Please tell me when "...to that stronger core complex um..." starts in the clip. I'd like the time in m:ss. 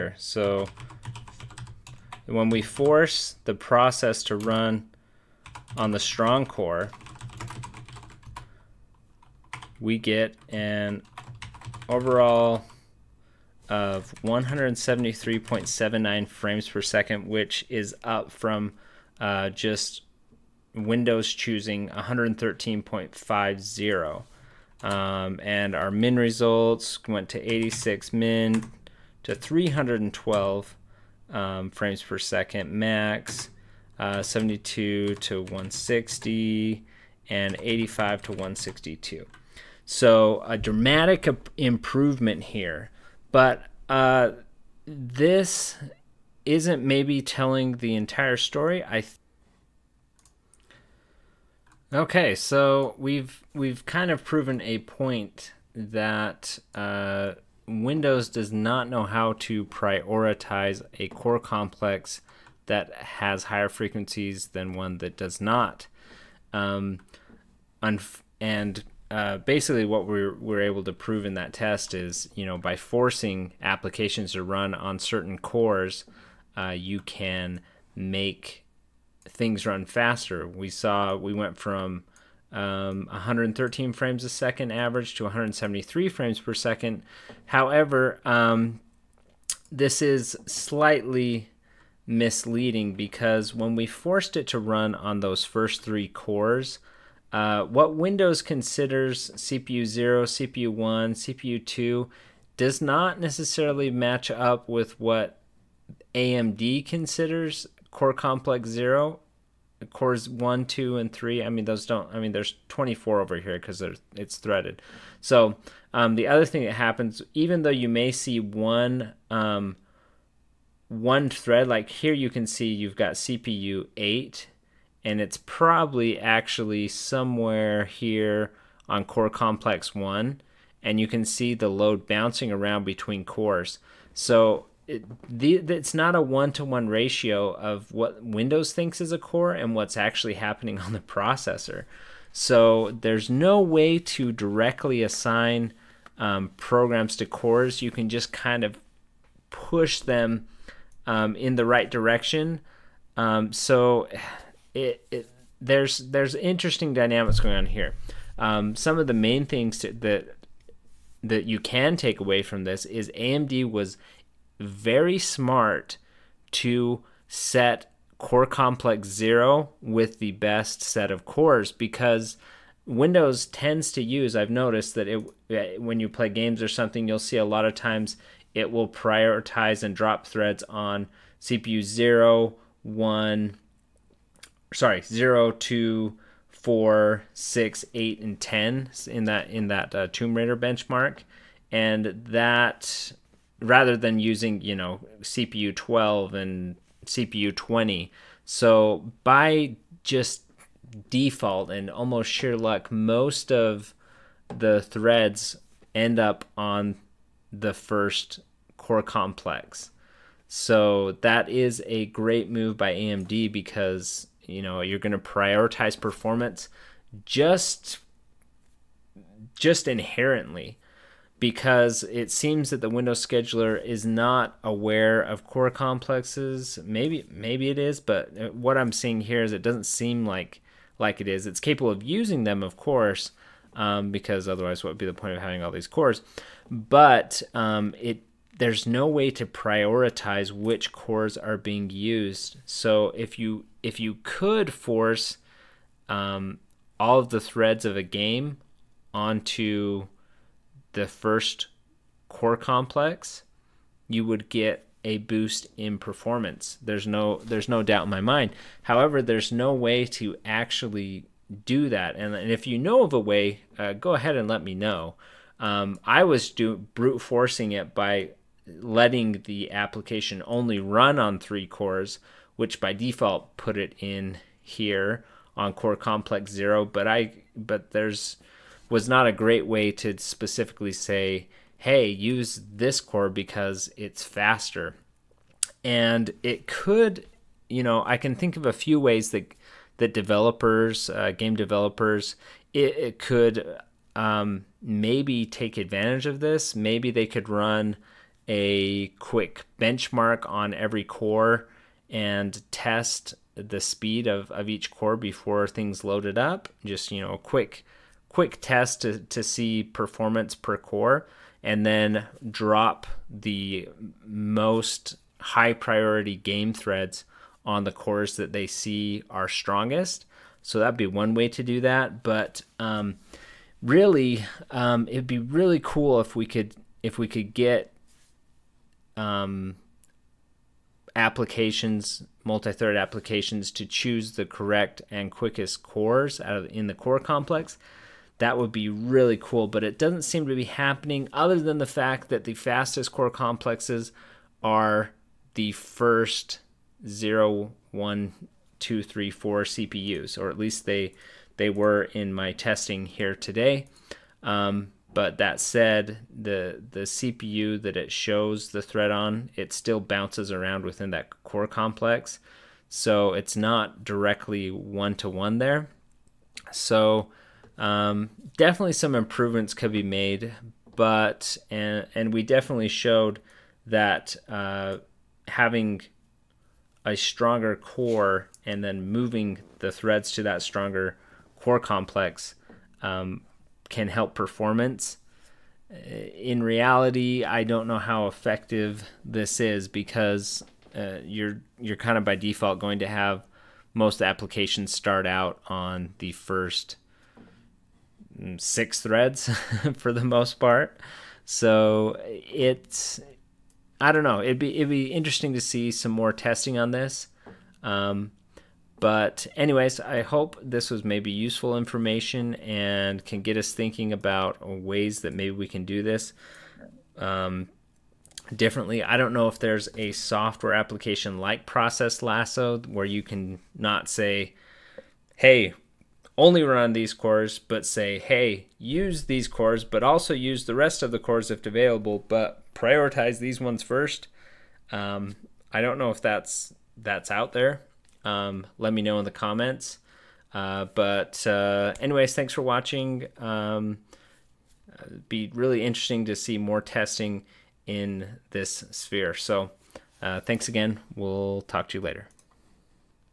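6:20.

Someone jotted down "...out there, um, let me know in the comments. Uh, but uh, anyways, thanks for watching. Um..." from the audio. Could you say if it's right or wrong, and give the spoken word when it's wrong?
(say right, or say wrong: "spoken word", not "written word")
right.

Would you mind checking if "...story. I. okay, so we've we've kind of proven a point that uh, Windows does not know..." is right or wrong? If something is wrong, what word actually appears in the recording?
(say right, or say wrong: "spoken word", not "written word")
right.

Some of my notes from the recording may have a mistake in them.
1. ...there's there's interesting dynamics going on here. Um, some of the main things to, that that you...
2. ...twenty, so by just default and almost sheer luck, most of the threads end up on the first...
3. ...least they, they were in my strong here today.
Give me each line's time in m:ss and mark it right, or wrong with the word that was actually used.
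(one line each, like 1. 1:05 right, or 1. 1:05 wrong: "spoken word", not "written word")
1. 2:35 right
2. 3:17 right
3. 5:50 wrong: "testing", not "strong".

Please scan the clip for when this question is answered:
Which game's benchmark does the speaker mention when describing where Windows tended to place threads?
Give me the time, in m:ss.
3:10.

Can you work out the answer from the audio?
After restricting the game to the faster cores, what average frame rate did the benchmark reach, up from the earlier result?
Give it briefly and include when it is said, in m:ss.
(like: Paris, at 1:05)
173 frames per second, at 1:25.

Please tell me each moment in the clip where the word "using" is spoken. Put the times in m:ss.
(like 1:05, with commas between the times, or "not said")
3:14, 3:52.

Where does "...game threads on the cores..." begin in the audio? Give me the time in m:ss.
5:16.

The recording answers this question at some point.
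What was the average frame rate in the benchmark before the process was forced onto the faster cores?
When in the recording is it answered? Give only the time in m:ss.
1:23.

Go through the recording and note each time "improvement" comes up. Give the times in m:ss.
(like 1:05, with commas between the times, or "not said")
0:41, 6:09.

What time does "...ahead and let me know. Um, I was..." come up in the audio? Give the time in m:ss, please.
4:24.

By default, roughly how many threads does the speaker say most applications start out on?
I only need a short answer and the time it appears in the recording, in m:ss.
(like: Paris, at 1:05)
6, at 6:36.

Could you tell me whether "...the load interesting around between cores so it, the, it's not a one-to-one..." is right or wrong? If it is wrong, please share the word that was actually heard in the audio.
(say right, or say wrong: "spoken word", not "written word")
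wrong: "bouncing", not "interesting".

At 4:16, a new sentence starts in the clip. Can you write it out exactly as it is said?
There's no there's no doubt in my mind.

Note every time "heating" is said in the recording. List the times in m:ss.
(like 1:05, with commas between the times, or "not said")
not said.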